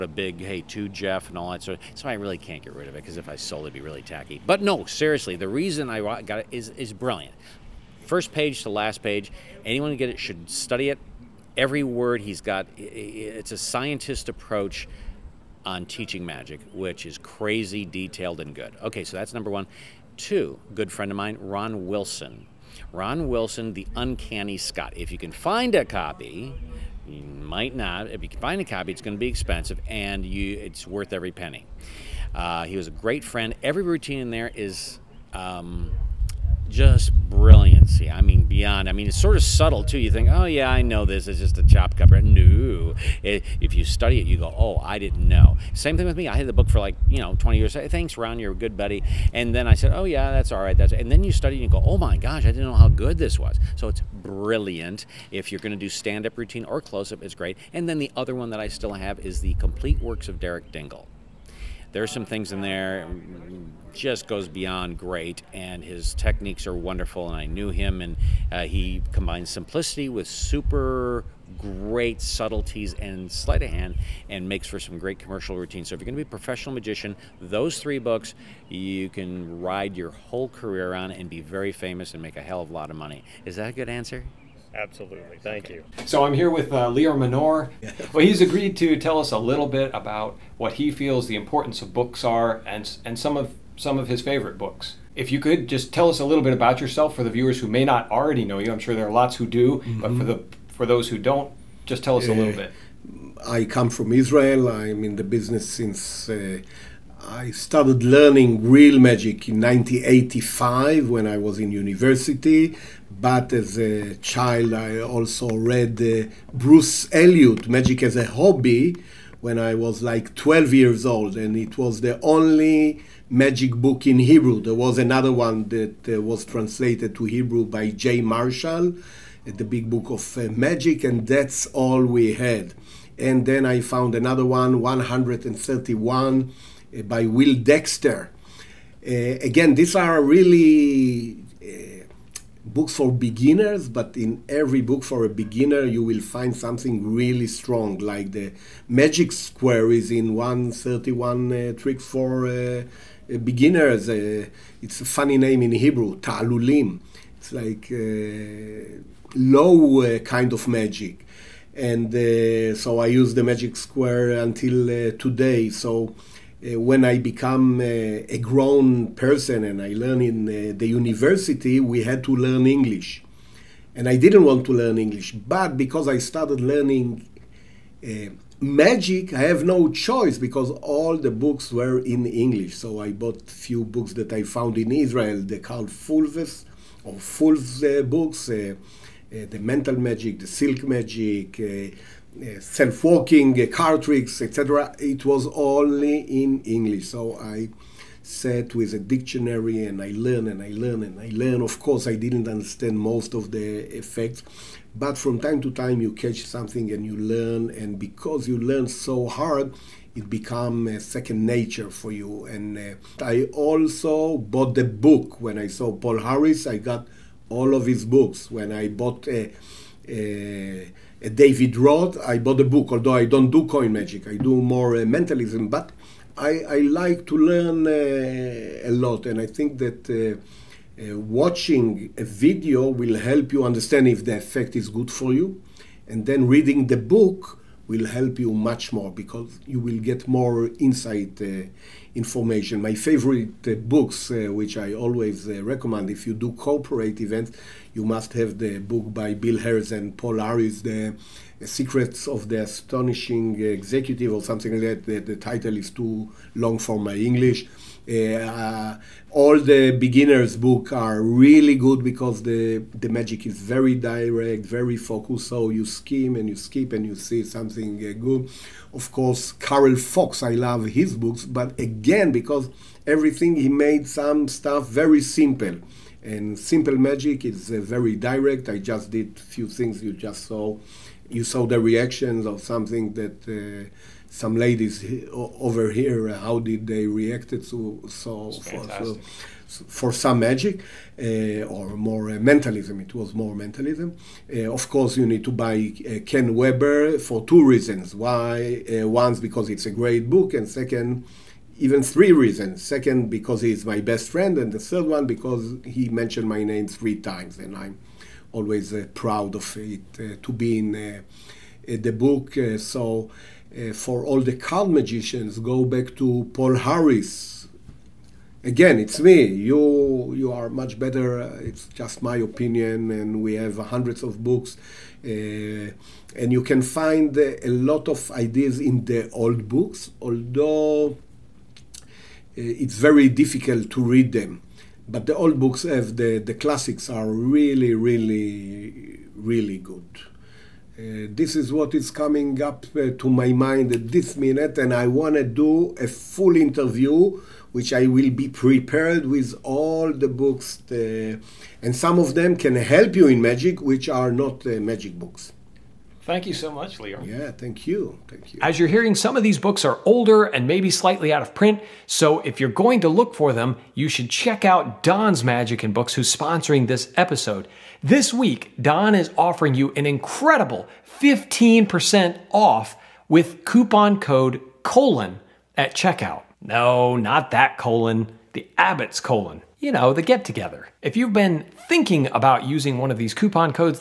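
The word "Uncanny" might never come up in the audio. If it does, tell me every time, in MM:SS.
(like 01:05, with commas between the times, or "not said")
00:23.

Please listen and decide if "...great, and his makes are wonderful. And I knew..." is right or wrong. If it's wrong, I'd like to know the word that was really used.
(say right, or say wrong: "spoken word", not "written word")
wrong: "techniques", not "makes".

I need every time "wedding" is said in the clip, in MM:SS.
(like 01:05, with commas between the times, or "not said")
not said.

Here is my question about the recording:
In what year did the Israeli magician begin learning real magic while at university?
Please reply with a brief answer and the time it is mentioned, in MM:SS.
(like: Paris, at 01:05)
1985, at 01:49.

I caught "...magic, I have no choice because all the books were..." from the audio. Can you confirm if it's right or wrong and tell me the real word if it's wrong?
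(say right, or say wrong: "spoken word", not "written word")
right.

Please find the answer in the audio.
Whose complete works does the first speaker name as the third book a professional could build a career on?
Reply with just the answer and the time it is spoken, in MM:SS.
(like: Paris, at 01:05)
Derek Dingle, at 01:00.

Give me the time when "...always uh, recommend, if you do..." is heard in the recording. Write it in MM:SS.
04:04.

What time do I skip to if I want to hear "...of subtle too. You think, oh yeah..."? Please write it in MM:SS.
00:39.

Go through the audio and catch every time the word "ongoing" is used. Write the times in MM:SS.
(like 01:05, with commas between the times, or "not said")
not said.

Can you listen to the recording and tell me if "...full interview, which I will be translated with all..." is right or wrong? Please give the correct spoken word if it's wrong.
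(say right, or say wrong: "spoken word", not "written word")
wrong: "prepared", not "translated".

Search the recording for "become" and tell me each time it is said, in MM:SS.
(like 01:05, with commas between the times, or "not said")
02:47, 03:30.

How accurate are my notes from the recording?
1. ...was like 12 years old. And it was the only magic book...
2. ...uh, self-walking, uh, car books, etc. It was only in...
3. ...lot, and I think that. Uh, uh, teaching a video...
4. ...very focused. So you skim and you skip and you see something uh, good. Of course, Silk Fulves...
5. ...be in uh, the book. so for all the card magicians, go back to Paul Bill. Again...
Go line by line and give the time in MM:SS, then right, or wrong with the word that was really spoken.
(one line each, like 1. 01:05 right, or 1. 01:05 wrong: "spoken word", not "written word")
1. 01:59 right
2. 03:12 wrong: "tricks", not "books"
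3. 03:48 wrong: "watching", not "teaching"
4. 04:24 wrong: "Karl", not "Silk"
5. 05:10 wrong: "Harris", not "Bill".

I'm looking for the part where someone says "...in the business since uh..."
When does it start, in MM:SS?
01:45.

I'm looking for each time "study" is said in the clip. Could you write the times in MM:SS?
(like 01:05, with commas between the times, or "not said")
00:10, 00:43, 00:51.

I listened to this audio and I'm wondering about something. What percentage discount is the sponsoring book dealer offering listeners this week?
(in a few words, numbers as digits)
15%.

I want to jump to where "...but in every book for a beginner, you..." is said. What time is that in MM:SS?
02:23.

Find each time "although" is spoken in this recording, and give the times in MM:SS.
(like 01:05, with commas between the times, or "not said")
03:42, 05:30.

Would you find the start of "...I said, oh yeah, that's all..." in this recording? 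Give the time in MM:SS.
00:49.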